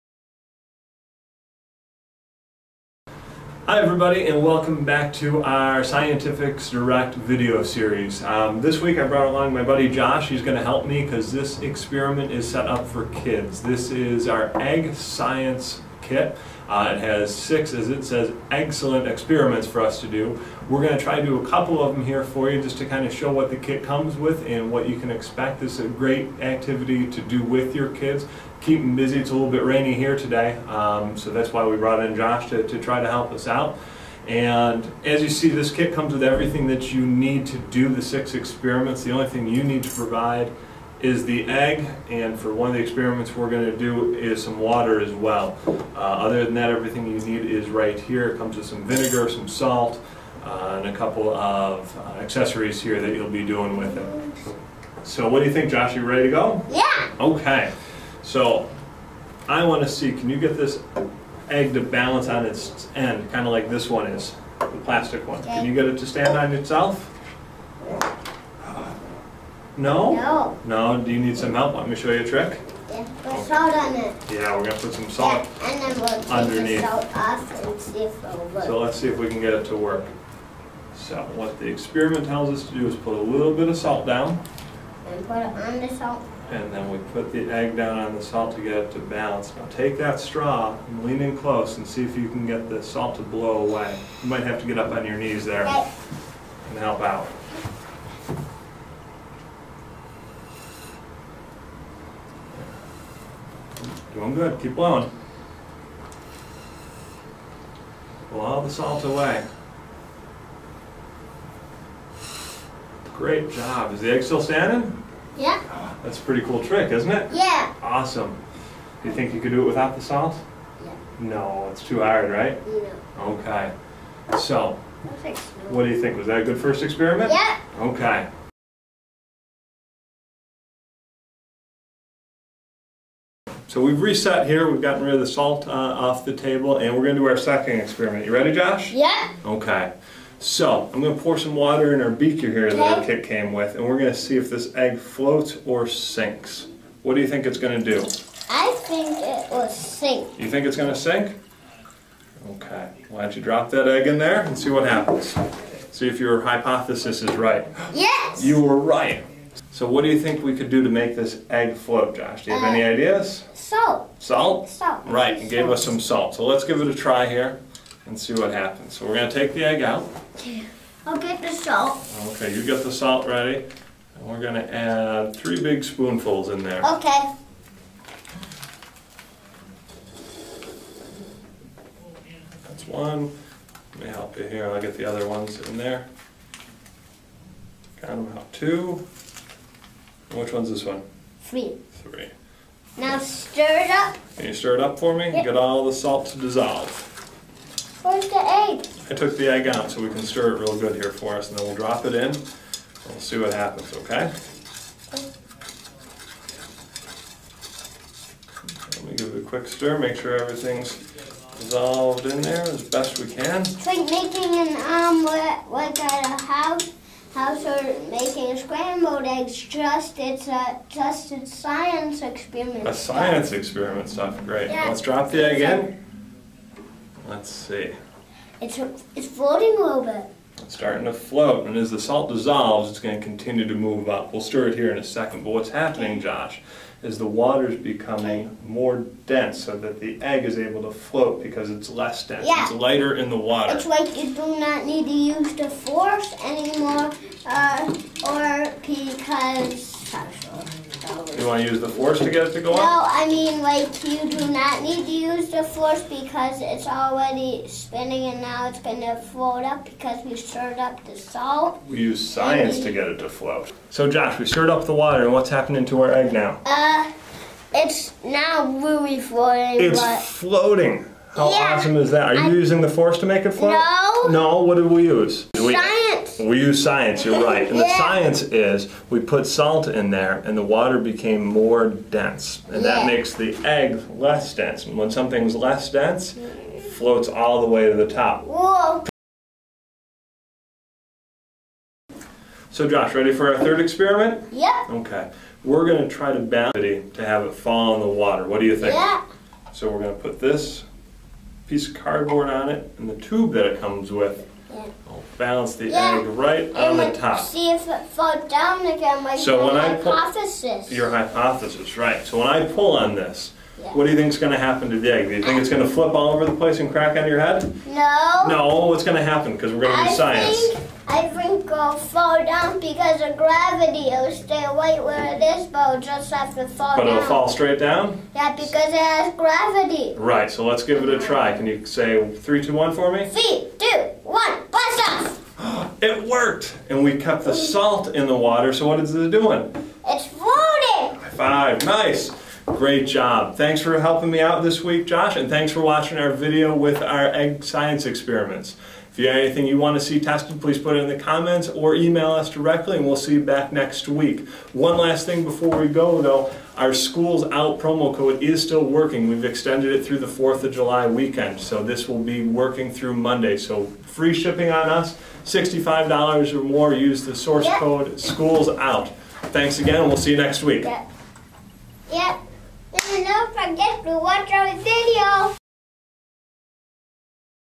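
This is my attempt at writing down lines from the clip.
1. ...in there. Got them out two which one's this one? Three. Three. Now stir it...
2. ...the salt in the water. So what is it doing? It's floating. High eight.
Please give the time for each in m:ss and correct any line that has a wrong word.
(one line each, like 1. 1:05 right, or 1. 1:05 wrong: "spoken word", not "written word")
1. 3:05 right
2. 5:37 wrong: "five", not "eight".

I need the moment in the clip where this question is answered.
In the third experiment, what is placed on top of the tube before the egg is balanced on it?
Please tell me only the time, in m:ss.
5:01.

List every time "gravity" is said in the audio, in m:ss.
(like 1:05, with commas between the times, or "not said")
5:23, 5:29.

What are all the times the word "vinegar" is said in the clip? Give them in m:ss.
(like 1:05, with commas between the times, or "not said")
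0:48.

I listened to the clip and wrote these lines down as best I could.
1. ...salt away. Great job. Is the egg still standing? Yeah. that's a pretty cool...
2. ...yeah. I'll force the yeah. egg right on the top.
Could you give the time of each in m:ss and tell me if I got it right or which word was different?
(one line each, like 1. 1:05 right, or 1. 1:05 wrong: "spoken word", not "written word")
1. 1:48 right
2. 5:04 wrong: "balance", not "force".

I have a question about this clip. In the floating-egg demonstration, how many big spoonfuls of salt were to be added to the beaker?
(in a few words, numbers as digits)
3.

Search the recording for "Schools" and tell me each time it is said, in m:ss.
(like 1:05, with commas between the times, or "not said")
5:56, 6:08.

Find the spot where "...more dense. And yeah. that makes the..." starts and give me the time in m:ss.
4:41.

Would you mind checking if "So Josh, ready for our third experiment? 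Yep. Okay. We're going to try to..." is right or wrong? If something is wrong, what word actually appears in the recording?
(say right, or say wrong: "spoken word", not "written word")
right.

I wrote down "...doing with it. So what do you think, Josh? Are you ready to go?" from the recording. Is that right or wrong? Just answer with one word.
right.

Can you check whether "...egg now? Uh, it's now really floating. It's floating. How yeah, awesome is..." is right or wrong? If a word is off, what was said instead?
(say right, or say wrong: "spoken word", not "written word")
right.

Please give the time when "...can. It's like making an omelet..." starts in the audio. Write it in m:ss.
3:33.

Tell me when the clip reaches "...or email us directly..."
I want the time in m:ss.
5:51.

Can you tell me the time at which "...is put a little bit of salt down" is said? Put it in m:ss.
1:22.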